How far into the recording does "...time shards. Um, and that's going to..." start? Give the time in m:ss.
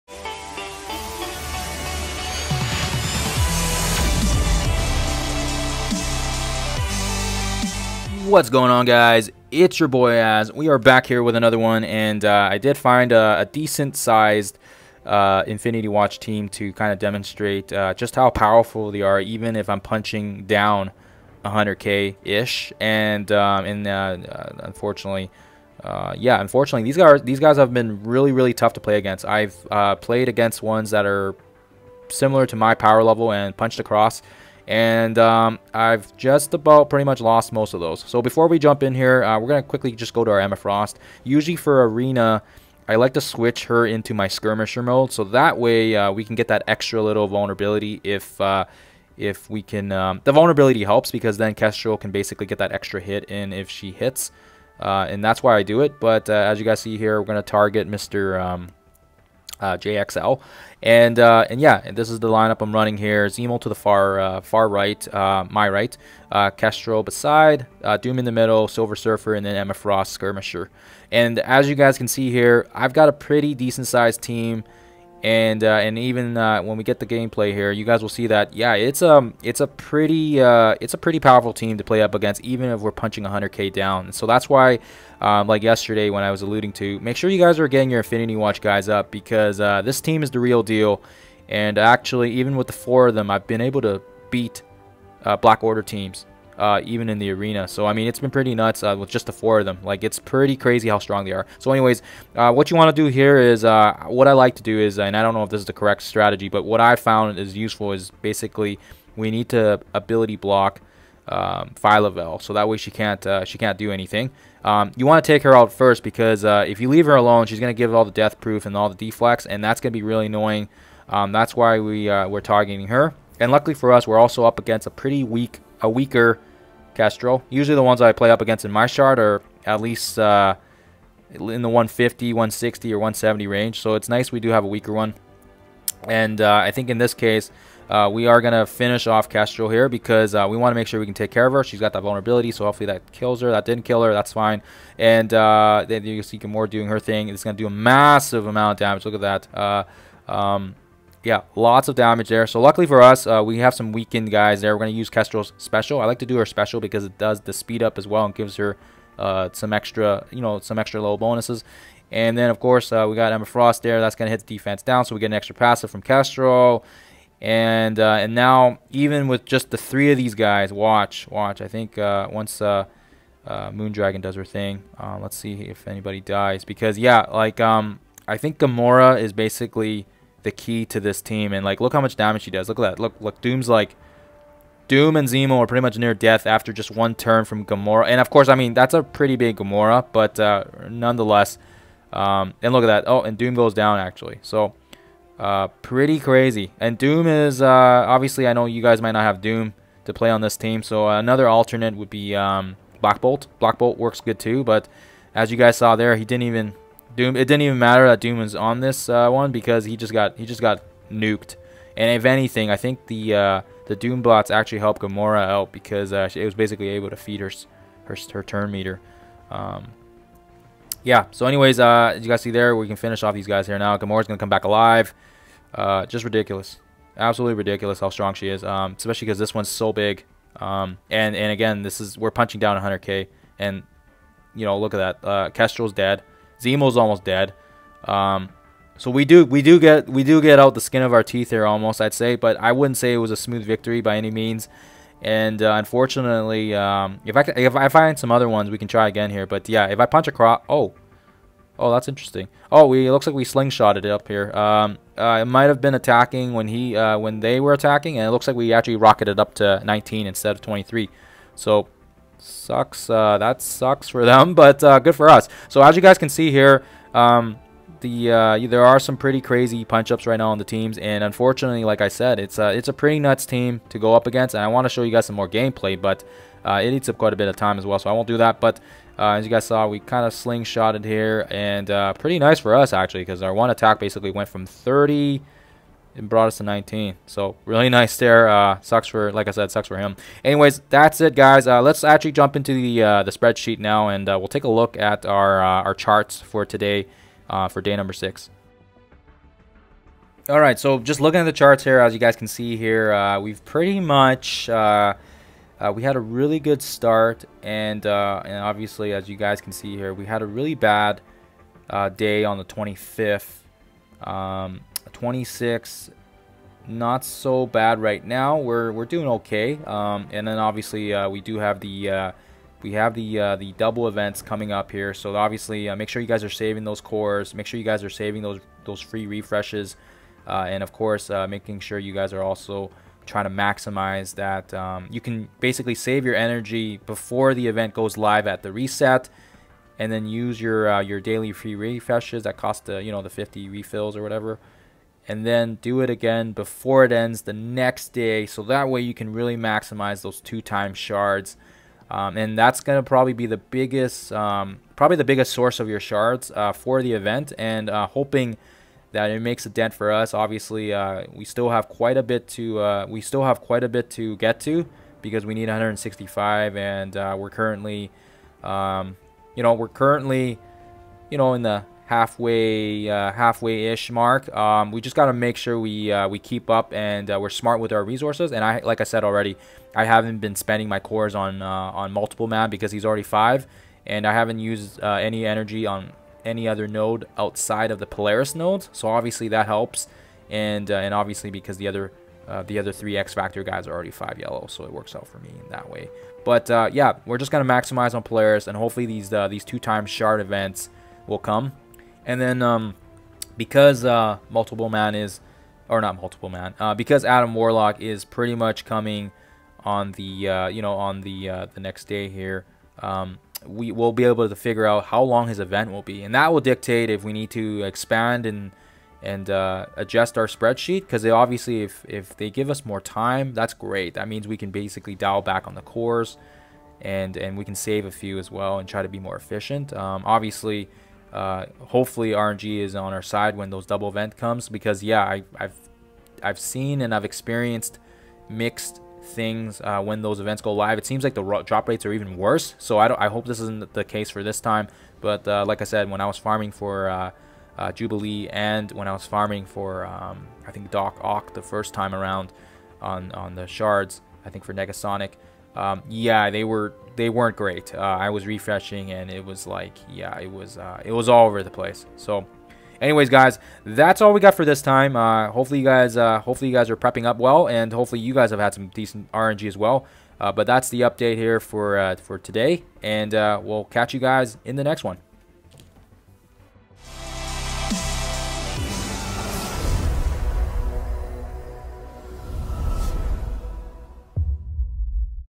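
5:50.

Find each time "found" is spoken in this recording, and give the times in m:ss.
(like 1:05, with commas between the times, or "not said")
1:46.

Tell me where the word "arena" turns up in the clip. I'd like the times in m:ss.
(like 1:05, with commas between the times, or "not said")
0:41, 1:37.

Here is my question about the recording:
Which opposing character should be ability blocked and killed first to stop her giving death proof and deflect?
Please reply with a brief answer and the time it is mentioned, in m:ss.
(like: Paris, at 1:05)
Phyla-Vell, at 1:51.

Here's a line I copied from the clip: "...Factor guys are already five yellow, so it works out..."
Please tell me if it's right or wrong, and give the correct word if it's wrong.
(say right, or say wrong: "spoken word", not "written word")
right.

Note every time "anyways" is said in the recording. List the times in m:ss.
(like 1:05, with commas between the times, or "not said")
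1:41, 3:41, 4:50, 7:43.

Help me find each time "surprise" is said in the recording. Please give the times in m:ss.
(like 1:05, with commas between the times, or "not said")
not said.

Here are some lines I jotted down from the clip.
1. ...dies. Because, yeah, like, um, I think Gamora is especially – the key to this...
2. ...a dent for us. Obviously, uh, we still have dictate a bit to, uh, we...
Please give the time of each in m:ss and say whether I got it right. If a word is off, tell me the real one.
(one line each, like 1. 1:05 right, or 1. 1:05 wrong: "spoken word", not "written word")
1. 2:56 wrong: "basically", not "especially"
2. 5:59 wrong: "quite", not "dictate".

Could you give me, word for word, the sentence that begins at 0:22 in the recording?
And um, and uh, uh, unfortunately, uh, yeah, unfortunately, these guys these guys have been really really tough to play against.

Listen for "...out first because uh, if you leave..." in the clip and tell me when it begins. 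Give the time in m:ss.
1:55.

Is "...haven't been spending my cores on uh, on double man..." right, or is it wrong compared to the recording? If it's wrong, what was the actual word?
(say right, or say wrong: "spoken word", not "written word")
wrong: "multiple", not "double".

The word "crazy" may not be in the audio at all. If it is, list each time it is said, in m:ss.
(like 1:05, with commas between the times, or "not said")
1:40, 3:16, 4:29.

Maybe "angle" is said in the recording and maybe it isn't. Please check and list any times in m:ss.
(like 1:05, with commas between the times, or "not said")
not said.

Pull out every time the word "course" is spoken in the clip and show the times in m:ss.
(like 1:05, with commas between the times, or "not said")
2:42, 3:08, 5:30.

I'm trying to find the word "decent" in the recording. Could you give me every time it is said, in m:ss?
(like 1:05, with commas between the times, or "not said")
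0:13, 1:13, 7:48.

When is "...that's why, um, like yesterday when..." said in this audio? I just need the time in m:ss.
1:24.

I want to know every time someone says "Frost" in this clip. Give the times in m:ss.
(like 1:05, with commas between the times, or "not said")
0:40, 1:09, 2:43.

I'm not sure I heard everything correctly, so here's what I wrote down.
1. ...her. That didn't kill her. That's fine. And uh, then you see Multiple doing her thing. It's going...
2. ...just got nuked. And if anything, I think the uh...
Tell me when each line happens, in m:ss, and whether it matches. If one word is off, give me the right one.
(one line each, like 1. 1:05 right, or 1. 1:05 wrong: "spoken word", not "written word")
1. 2:23 wrong: "Gamora", not "Multiple"
2. 3:30 right.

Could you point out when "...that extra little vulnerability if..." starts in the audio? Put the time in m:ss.
0:46.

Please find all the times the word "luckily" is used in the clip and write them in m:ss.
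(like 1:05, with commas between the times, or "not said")
2:03, 2:32.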